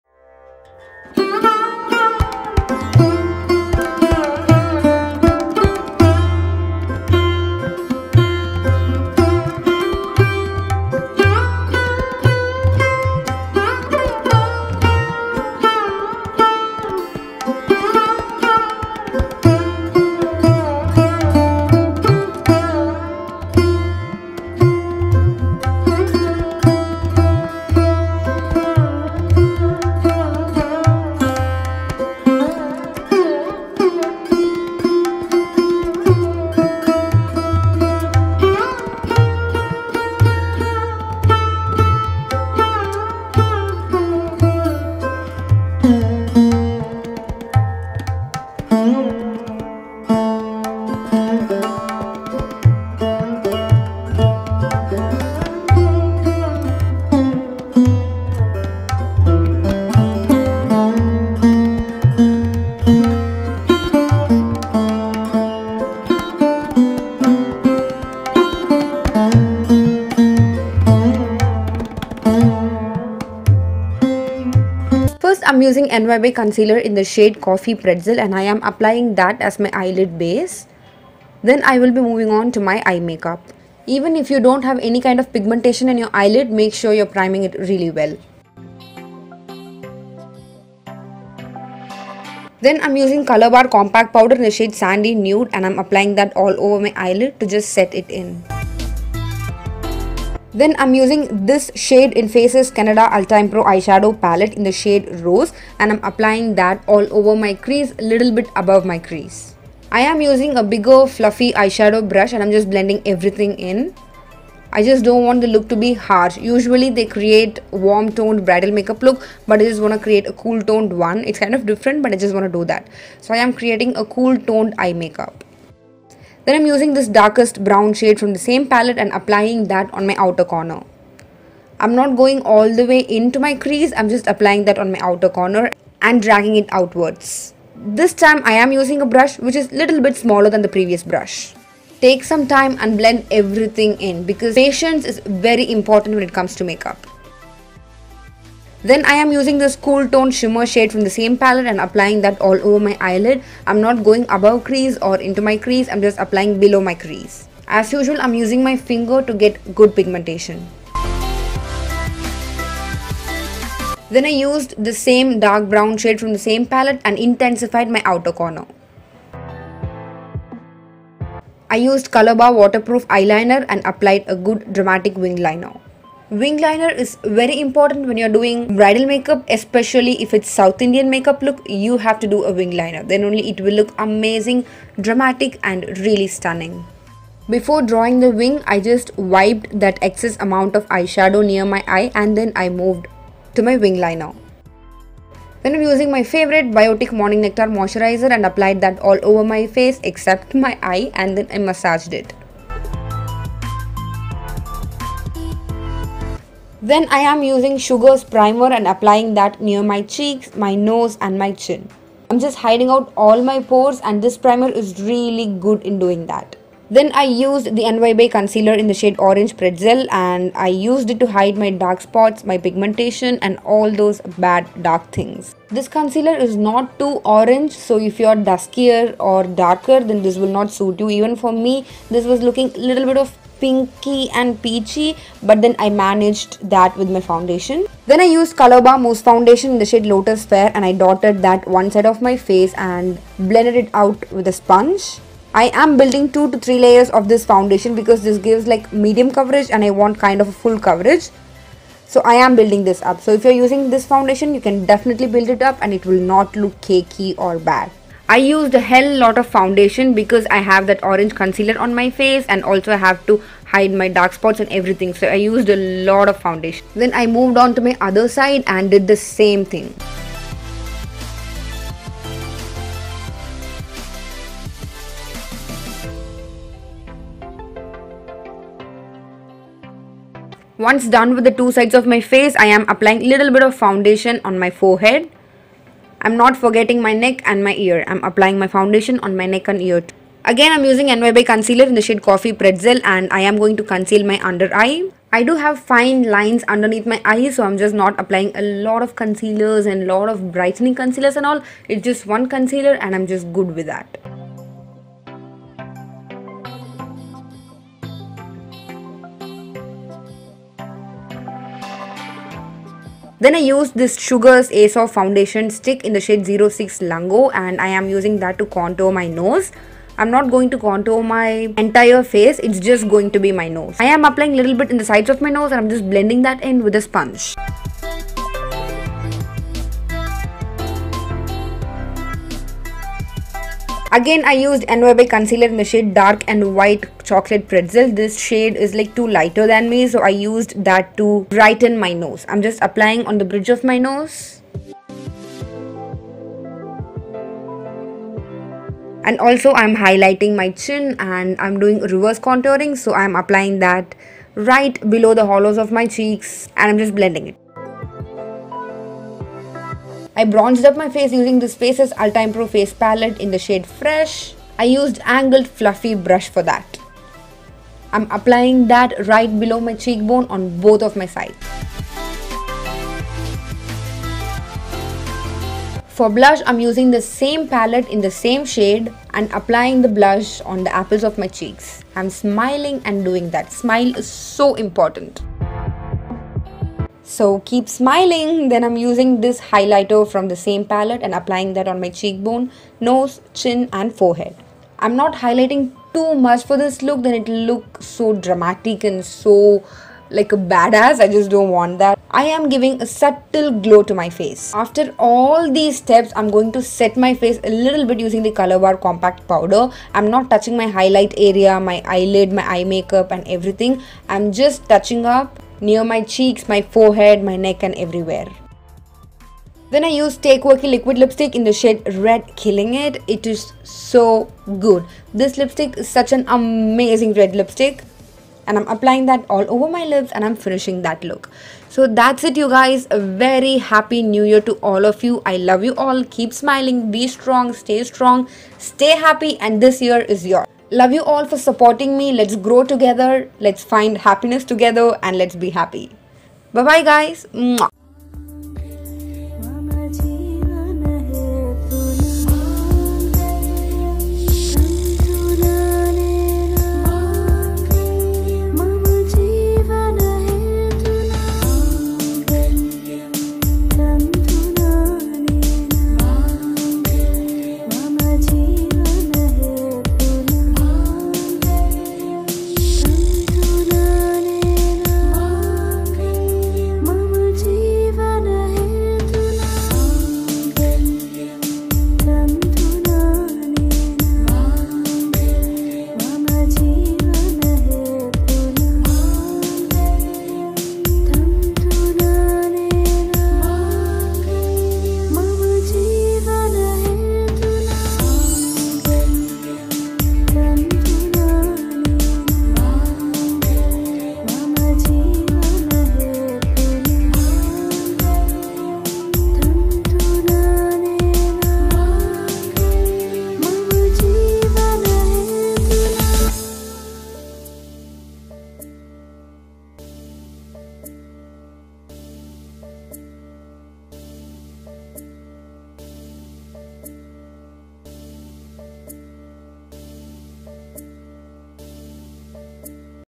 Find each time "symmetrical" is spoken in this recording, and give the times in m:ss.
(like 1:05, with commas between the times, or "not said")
not said.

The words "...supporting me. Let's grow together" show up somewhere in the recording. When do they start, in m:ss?
7:21.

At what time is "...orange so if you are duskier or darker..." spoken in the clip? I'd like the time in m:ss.
3:47.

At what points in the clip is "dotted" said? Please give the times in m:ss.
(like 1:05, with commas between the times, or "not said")
4:01.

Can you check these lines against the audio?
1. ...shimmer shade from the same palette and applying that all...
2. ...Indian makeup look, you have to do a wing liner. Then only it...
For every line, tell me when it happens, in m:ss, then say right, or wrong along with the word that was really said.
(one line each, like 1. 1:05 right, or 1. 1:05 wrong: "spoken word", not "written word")
1. 2:30 right
2. 3:00 right.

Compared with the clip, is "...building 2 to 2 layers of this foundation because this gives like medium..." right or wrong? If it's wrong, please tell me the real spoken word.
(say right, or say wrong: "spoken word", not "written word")
wrong: "3", not "2".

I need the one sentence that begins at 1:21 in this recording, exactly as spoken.
Then I will be moving on to my eye makeup.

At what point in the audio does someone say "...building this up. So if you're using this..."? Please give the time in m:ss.
4:12.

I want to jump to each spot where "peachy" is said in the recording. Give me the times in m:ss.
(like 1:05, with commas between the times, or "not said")
3:54.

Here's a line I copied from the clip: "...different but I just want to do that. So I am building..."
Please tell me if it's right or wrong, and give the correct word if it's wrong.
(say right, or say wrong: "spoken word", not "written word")
wrong: "creating", not "building".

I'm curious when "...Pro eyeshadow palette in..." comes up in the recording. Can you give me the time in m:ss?
1:43.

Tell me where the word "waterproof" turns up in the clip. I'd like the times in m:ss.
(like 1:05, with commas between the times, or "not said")
2:52.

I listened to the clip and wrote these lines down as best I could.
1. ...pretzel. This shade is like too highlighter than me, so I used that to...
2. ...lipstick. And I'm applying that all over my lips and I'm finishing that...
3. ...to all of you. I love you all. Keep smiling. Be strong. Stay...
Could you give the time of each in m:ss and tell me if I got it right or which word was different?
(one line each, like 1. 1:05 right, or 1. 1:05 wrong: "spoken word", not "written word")
1. 5:37 wrong: "lighter", not "highlighter"
2. 7:07 right
3. 7:14 right.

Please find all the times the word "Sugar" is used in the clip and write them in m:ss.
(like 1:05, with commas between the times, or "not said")
3:27, 5:14.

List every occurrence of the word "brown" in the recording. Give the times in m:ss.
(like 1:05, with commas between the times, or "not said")
2:07, 2:45.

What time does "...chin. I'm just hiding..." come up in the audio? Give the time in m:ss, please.
3:31.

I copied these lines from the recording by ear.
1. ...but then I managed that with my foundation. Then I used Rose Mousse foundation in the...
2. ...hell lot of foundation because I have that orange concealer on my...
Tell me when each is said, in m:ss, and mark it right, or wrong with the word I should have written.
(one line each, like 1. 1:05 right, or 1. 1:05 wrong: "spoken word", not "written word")
1. 3:55 wrong: "Colorbar", not "Rose"
2. 4:18 right.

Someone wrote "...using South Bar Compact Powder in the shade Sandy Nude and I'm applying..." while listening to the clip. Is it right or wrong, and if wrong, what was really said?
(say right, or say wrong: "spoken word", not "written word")
wrong: "Color", not "South".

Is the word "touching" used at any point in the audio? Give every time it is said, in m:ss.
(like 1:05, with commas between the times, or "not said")
6:50, 6:54.